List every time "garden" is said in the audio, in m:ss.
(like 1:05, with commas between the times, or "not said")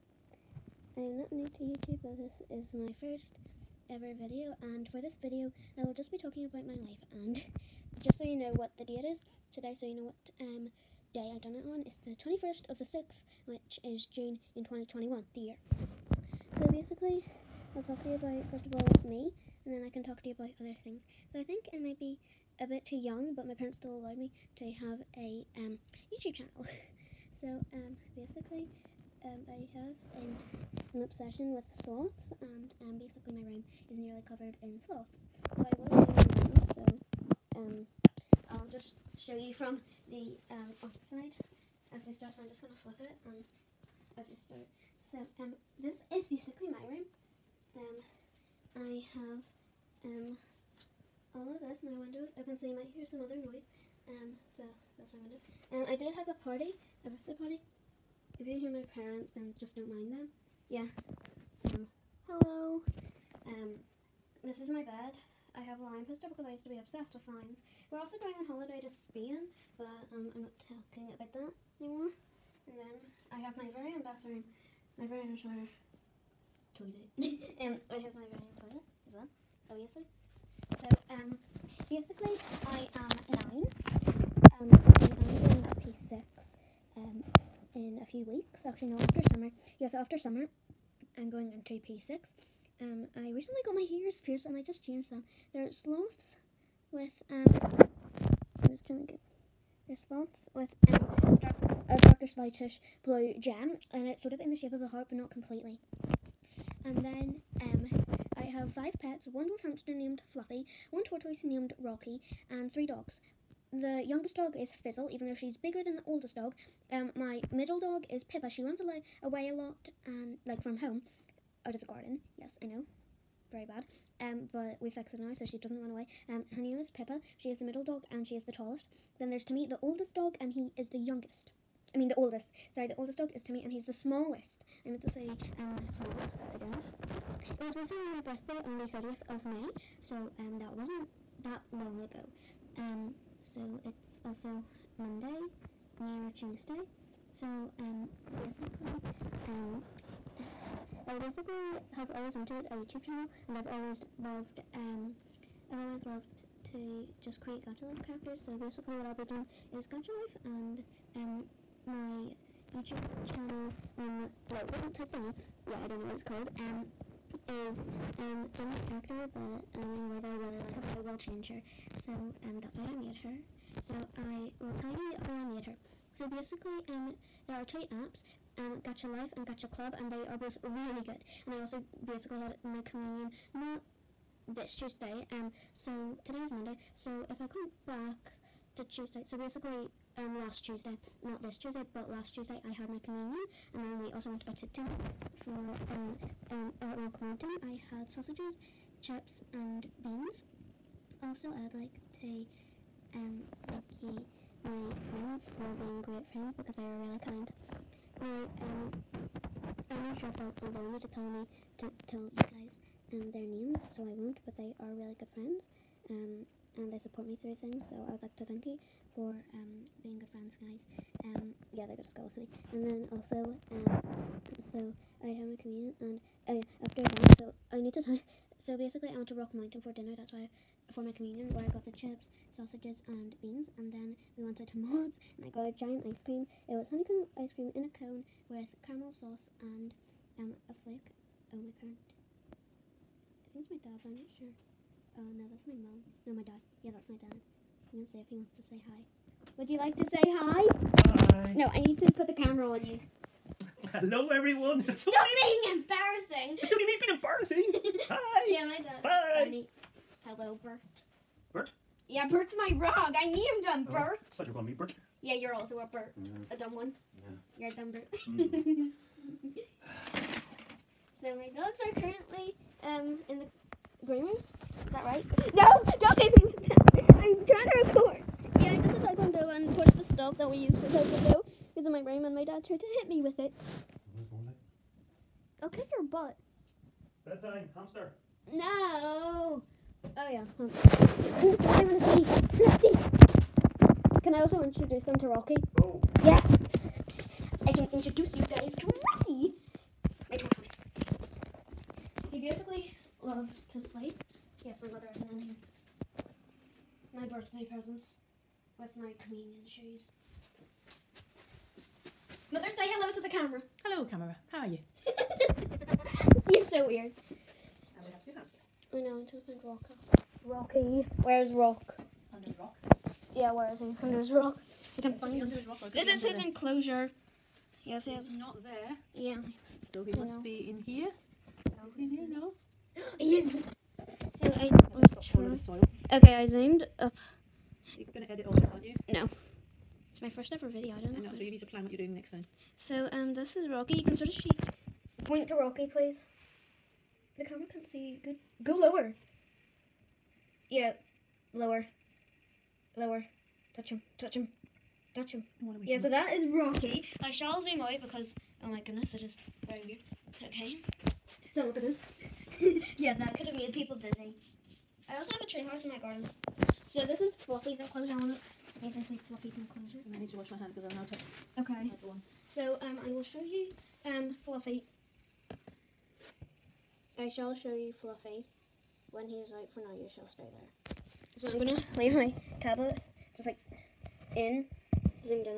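2:01, 6:05.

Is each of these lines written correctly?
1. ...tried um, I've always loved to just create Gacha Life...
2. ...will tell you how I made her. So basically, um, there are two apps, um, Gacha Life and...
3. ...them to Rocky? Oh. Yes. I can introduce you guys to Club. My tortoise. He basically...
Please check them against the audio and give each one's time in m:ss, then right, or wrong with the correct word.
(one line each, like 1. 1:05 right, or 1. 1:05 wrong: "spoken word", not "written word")
1. 2:34 wrong: "loved", not "tried"
2. 2:54 right
3. 4:55 wrong: "Rocky", not "Club".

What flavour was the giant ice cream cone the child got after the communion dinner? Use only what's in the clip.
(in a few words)
Honeycomb.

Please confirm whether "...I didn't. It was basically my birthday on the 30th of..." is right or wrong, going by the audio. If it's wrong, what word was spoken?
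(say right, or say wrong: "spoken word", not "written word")
wrong: "recently", not "basically".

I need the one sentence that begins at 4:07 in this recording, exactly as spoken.
I'm gonna say if he wants to say hi.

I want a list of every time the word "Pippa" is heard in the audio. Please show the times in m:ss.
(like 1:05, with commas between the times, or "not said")
1:58, 2:06.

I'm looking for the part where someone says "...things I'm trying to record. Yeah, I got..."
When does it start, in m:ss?
4:36.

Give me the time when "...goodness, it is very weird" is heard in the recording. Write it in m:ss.
5:58.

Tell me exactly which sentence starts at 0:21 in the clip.
So I think I might be a bit too young, but my parents still allowed me to have a um, YouTube channel.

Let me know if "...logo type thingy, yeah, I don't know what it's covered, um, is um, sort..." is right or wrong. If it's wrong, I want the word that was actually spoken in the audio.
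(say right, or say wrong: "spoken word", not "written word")
wrong: "called", not "covered".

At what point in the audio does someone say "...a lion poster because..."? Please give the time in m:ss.
1:05.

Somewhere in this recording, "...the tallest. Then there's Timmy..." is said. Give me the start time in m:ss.
2:08.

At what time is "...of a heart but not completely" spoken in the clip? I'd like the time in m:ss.
1:44.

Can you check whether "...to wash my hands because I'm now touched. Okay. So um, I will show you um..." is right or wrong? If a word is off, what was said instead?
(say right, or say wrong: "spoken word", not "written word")
right.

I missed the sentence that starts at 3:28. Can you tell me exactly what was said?
Now, um, I'm not sure if they'll allow me to tell me to tell you guys um, their names, so I won't.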